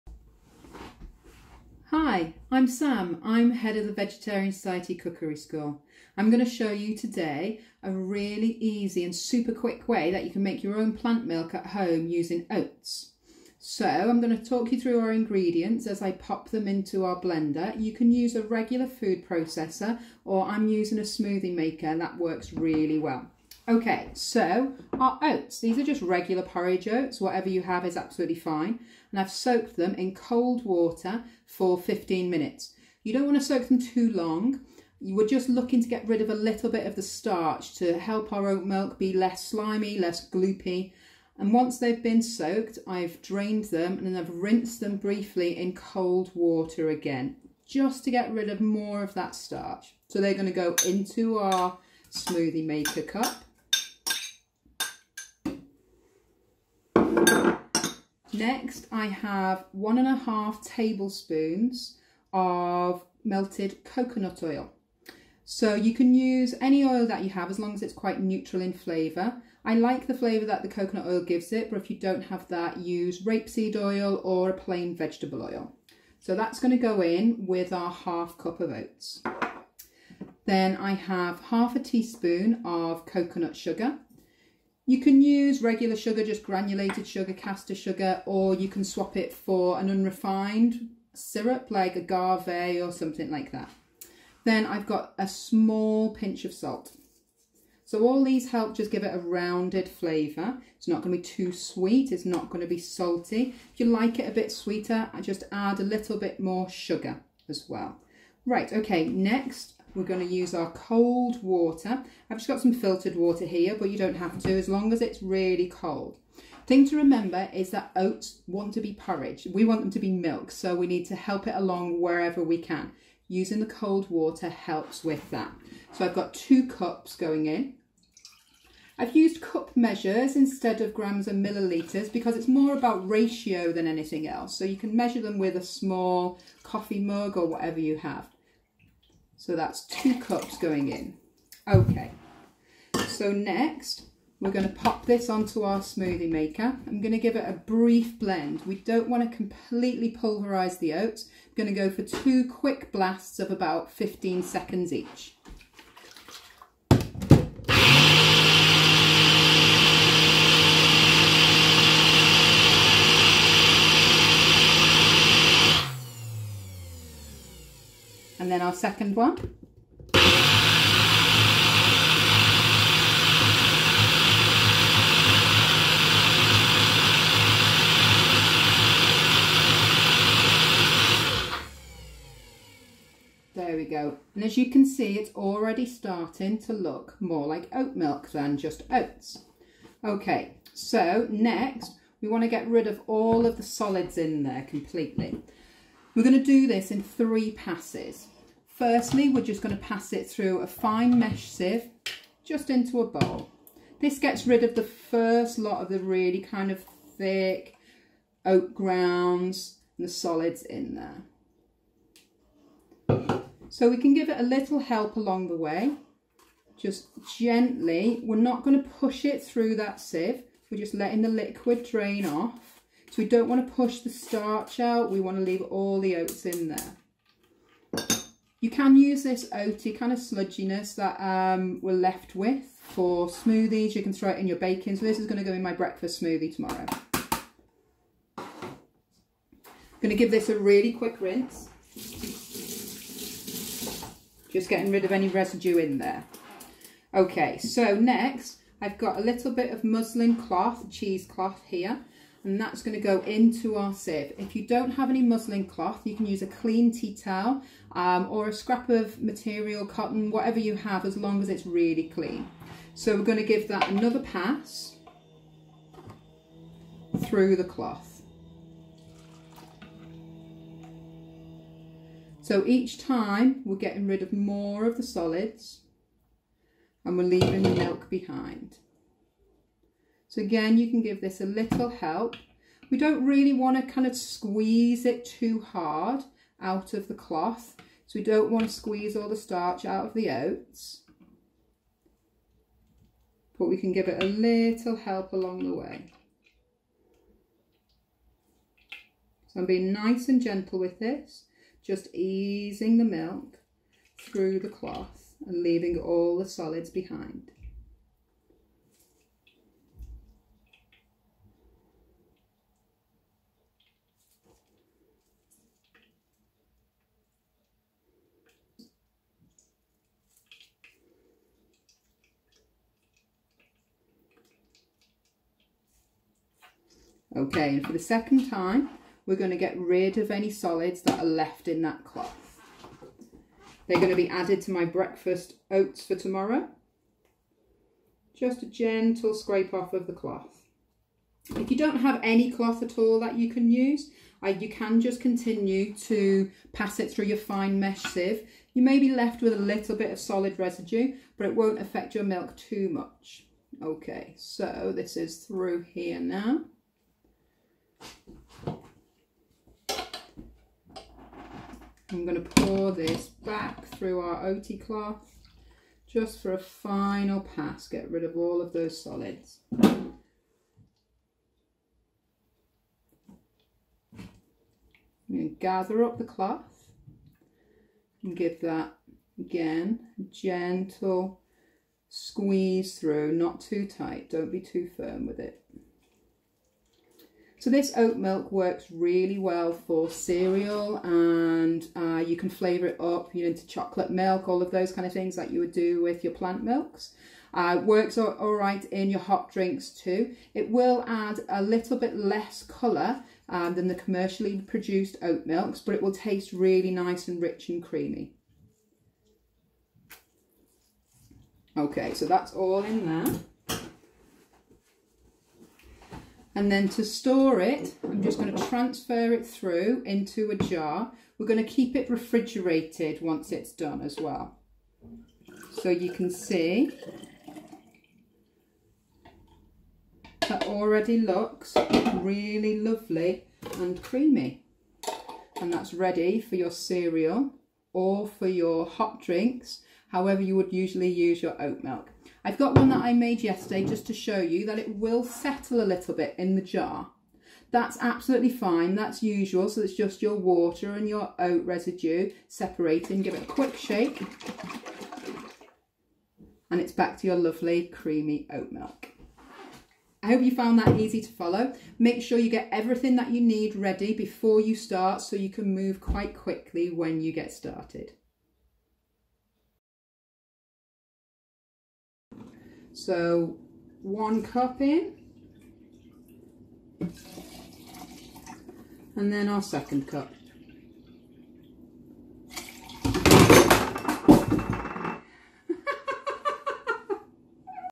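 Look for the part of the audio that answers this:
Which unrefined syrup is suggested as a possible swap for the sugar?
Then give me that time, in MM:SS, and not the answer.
01:31.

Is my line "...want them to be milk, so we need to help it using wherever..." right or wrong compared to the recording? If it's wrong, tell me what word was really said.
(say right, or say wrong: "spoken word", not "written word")
wrong: "along", not "using".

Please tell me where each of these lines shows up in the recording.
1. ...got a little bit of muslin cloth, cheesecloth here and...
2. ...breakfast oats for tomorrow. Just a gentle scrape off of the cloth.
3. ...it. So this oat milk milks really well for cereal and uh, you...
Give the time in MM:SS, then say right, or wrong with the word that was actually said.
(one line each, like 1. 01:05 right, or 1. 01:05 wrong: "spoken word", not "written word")
1. 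04:08 right
2. 05:34 right
3. 06:25 wrong: "works", not "milks".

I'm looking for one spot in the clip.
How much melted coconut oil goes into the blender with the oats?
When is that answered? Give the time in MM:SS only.
00:59.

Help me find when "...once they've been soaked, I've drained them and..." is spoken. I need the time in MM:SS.
00:41.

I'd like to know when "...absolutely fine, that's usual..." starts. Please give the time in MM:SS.
07:28.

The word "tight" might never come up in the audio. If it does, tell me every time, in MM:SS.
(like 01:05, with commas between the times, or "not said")
06:23.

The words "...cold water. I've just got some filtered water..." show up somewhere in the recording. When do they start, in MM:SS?
01:50.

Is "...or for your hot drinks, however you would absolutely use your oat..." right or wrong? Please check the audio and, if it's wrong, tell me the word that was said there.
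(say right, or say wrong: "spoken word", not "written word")
wrong: "usually", not "absolutely".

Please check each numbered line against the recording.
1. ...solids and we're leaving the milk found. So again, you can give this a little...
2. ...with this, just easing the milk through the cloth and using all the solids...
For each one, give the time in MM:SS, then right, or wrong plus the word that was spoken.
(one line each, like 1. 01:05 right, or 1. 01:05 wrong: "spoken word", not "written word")
1. 04:35 wrong: "behind", not "found"
2. 05:00 wrong: "leaving", not "using".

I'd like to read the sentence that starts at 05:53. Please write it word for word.
Okay, so this is through here now.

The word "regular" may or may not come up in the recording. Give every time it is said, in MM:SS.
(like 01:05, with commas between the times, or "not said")
00:18, 00:26, 01:25.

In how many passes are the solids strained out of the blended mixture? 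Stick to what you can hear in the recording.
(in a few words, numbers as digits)
3.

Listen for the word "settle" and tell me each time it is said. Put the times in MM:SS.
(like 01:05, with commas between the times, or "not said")
07:25.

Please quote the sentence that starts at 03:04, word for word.
And as you can see, it's already starting to look more like oat milk than just oats.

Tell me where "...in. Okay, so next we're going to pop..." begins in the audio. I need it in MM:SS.
02:20.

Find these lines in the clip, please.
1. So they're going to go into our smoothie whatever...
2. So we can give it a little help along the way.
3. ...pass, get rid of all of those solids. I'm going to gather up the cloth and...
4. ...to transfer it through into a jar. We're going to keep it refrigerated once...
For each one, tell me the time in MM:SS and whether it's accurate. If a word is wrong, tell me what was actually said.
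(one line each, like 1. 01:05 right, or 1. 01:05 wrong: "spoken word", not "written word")
1. 00:50 wrong: "maker", not "whatever"
2. 03:33 right
3. 06:07 right
4. 06:58 right.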